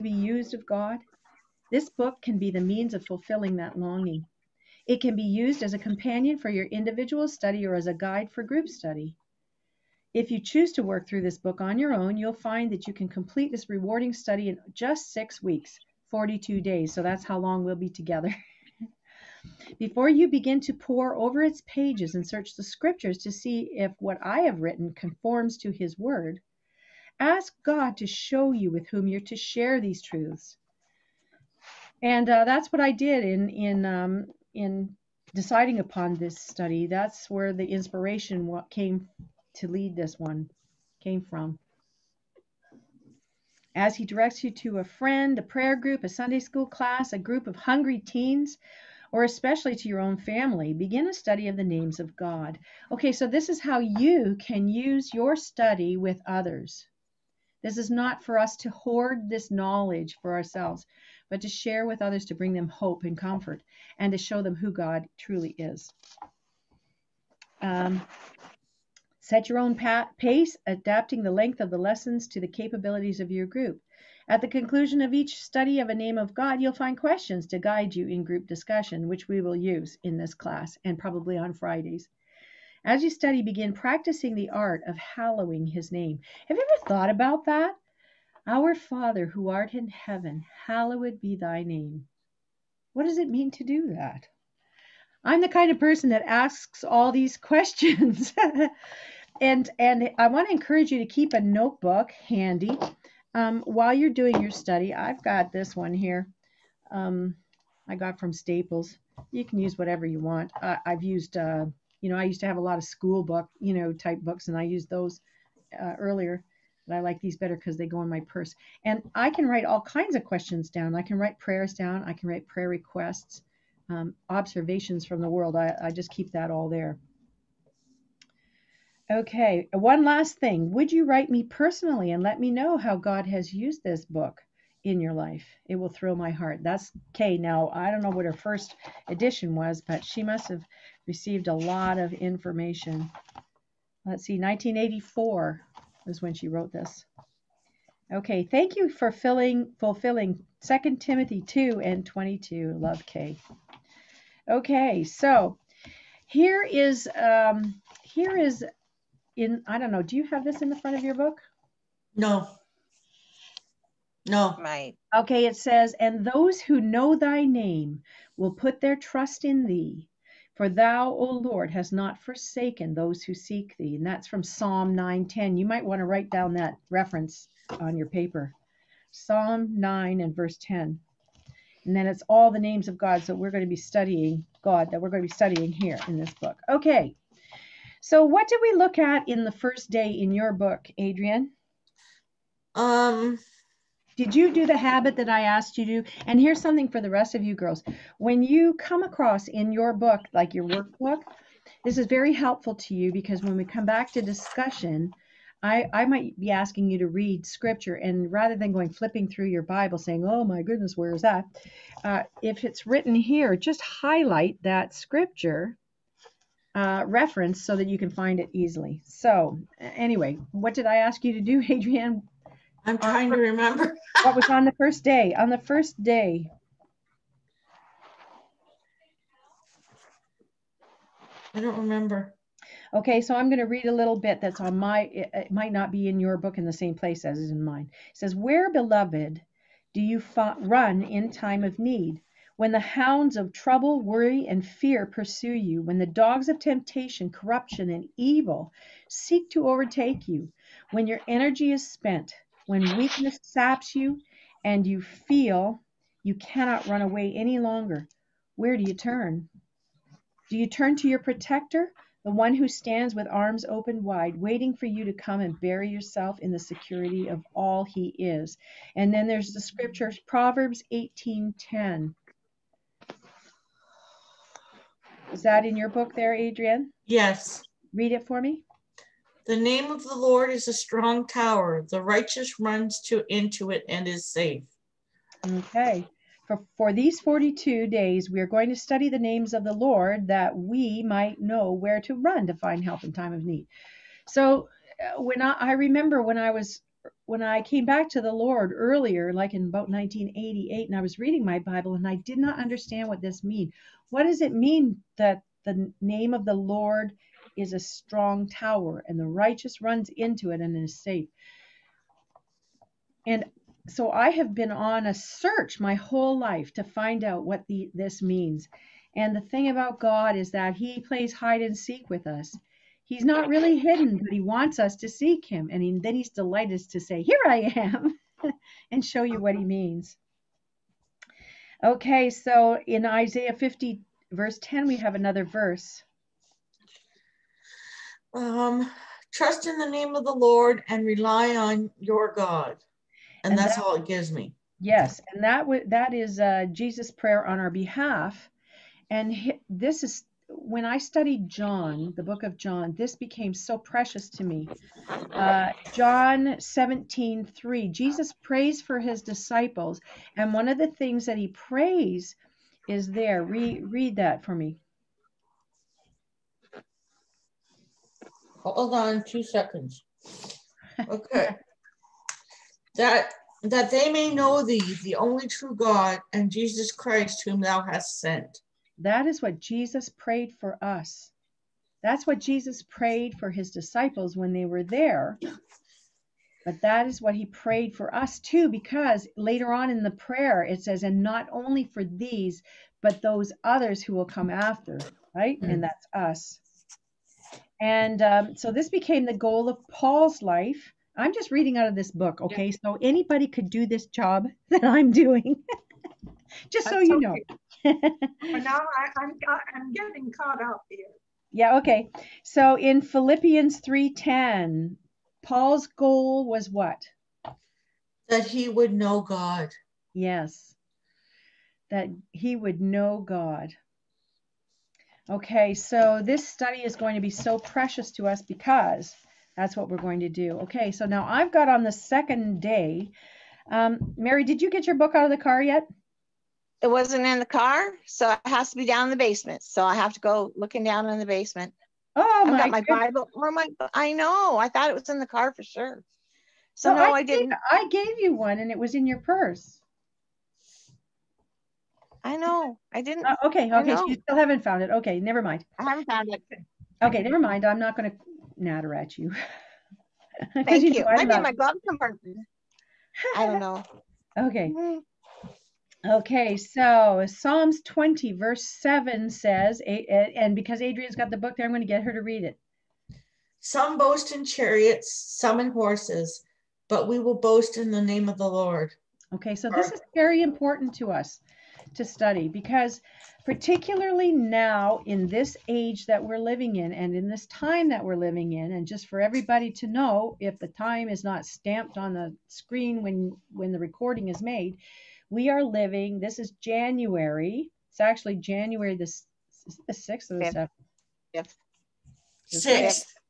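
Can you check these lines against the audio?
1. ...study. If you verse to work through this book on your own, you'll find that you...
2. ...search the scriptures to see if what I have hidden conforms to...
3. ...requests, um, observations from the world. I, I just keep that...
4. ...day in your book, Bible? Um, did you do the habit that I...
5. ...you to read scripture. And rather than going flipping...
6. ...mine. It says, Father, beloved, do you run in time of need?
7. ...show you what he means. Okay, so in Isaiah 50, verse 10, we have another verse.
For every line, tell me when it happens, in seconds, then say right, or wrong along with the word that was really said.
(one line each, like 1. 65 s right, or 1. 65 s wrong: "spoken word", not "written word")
1. 8 s wrong: "choose", not "verse"
2. 22 s wrong: "written", not "hidden"
3. 122 s right
4. 189 s wrong: "Adrian", not "Bible"
5. 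206 s right
6. 237 s wrong: "Where", not "Father"
7. 329 s right.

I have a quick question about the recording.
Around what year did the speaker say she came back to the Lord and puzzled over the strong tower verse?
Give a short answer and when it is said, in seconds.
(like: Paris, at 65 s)
1988, at 299 s.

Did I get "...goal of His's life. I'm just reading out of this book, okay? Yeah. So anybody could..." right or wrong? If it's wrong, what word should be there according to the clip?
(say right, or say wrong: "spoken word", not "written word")
wrong: "Paul", not "His".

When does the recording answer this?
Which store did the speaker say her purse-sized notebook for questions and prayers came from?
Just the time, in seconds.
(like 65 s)
108 s.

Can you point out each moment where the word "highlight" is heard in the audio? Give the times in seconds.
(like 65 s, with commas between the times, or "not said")
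213 s.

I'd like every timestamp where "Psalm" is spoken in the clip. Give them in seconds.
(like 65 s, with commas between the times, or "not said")
174 s, 179 s, 467 s.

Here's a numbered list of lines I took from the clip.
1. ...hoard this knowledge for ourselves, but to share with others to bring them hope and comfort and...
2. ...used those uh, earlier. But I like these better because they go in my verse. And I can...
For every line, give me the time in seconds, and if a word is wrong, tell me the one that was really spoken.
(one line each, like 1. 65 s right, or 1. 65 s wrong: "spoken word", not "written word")
1. 58 s right
2. 114 s wrong: "purse", not "verse".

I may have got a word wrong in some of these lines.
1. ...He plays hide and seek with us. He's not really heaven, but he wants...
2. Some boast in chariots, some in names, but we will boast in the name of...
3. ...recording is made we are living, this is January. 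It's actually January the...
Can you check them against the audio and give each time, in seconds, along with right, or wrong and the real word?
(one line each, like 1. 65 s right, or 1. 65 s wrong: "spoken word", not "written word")
1. 320 s wrong: "hidden", not "heaven"
2. 473 s wrong: "horses", not "names"
3. 493 s right.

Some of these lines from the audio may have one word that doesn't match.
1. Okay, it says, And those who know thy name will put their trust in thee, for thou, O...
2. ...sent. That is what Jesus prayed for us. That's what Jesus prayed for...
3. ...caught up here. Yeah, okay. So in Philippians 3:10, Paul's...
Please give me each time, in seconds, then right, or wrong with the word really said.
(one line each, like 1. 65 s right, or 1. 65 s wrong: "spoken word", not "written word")
1. 165 s right
2. 378 s right
3. 410 s right.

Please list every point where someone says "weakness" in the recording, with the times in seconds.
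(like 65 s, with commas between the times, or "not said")
252 s.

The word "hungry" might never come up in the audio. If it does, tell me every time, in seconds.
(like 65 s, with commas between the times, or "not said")
47 s.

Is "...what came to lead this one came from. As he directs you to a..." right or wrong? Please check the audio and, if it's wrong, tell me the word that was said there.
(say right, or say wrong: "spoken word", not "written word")
right.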